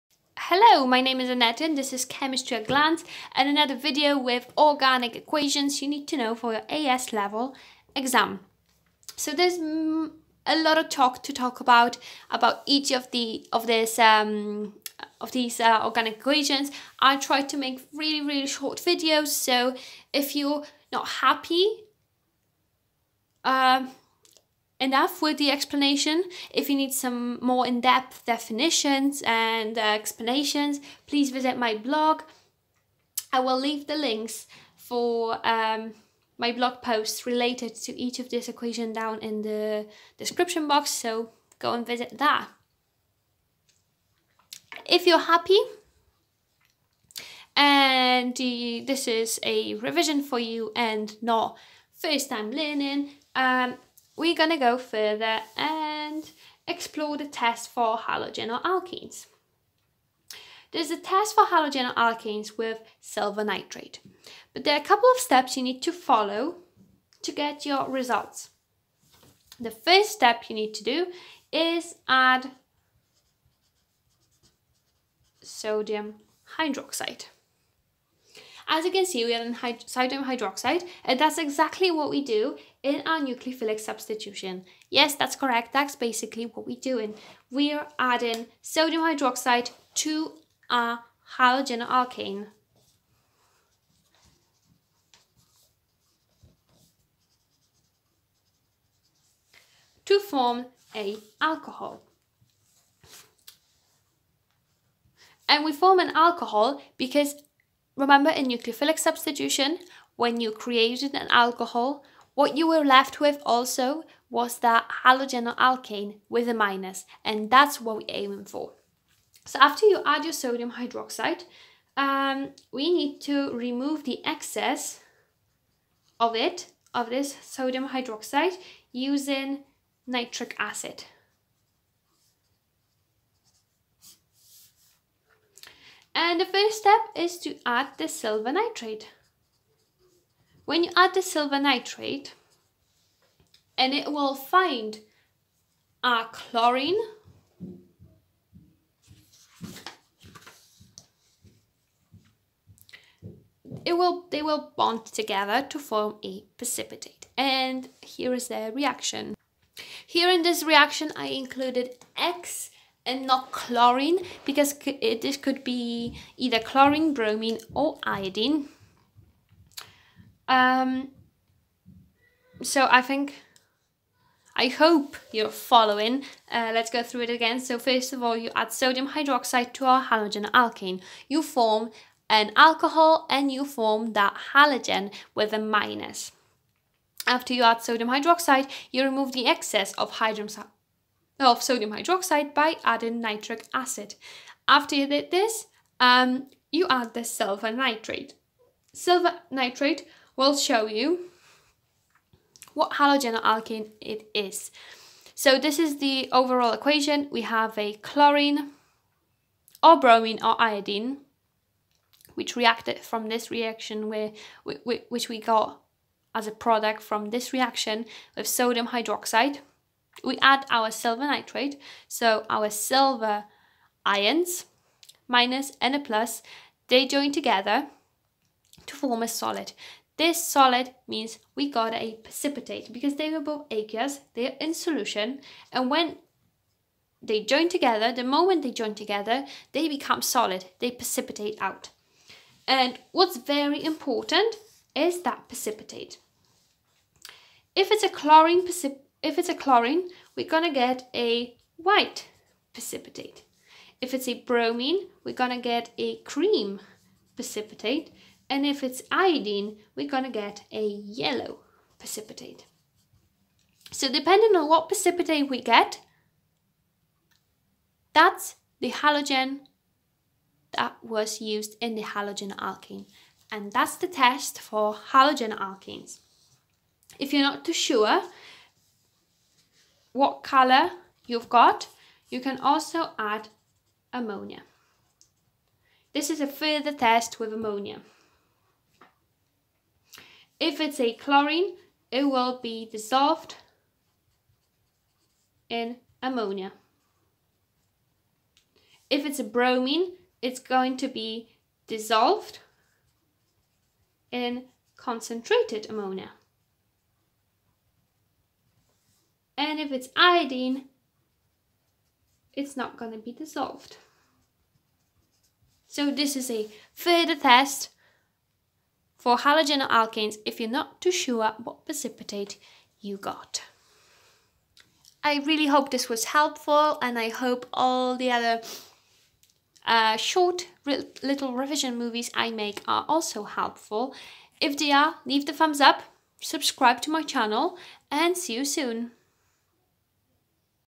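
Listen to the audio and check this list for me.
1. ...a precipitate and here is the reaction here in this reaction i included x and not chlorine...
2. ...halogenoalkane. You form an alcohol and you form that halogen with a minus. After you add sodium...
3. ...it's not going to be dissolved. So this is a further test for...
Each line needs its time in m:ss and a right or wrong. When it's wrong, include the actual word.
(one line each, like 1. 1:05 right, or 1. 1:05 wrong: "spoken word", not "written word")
1. 2:36 right
2. 3:00 right
3. 5:12 right.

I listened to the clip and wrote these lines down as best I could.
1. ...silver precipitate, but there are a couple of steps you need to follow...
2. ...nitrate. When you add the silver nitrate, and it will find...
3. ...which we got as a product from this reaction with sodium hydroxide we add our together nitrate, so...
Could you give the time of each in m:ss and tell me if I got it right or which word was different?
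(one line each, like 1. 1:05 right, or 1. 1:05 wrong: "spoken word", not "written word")
1. 1:03 wrong: "nitrate", not "precipitate"
2. 2:18 right
3. 3:34 wrong: "silver", not "together".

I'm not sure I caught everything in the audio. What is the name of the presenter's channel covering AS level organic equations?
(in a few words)
Chemistry at Glance.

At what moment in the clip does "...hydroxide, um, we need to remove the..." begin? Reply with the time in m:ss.
2:00.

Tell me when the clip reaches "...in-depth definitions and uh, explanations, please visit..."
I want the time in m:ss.
0:27.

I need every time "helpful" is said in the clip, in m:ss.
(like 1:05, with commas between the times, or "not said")
5:26, 5:33.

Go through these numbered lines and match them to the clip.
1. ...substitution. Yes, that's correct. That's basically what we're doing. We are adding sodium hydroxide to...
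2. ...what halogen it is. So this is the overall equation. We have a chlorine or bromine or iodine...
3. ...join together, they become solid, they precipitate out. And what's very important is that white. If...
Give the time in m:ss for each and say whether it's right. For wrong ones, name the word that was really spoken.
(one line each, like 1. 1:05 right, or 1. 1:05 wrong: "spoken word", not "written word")
1. 1:23 right
2. 3:22 right
3. 3:58 wrong: "precipitate", not "white".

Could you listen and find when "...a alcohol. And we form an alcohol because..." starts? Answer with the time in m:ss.
1:40.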